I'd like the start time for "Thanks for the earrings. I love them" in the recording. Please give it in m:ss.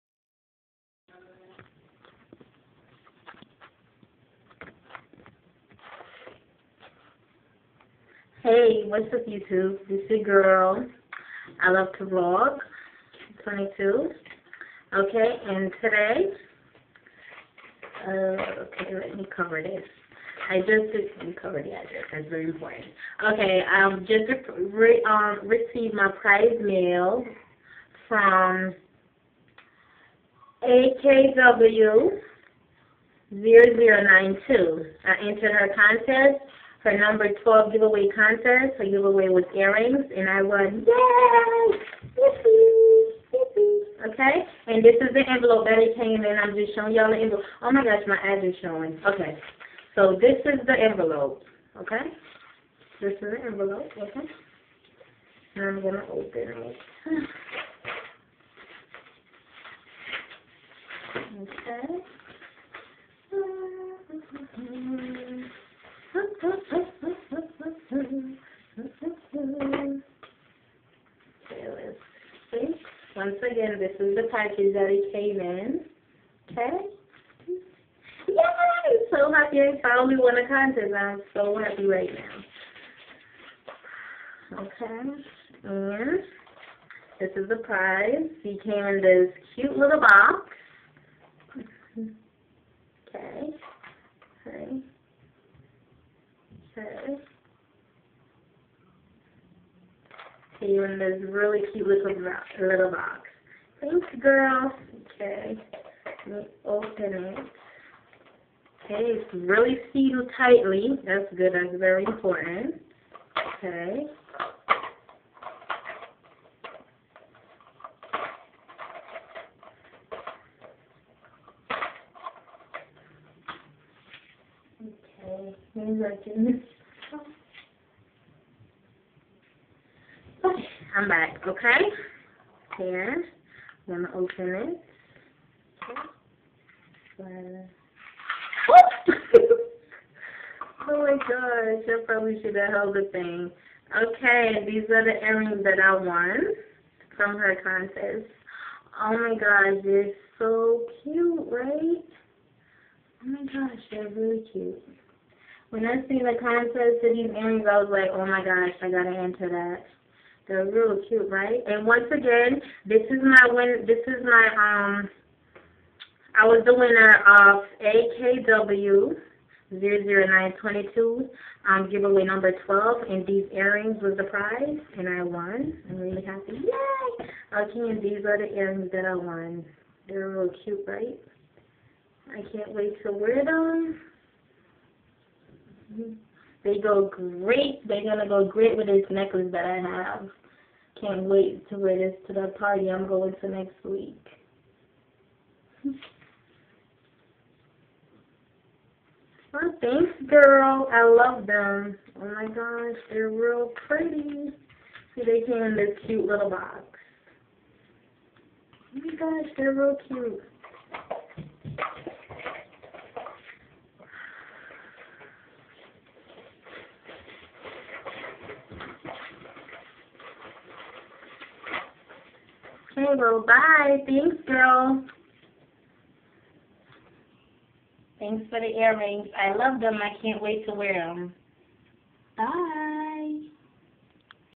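3:48.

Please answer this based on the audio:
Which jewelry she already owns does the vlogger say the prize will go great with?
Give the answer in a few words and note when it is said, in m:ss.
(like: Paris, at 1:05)
Necklace, at 3:09.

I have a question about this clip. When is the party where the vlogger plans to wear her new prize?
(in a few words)
Next week.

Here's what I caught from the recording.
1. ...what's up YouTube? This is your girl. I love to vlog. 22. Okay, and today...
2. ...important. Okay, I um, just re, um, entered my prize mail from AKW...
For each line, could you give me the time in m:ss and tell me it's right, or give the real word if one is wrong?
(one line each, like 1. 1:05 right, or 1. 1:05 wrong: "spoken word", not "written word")
1. 0:08 right
2. 0:22 wrong: "received", not "entered".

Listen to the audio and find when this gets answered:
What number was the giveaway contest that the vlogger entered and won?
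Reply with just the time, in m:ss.
0:36.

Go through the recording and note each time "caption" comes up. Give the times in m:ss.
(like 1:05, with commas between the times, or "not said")
not said.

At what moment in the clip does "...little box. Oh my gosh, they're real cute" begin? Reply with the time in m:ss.
3:26.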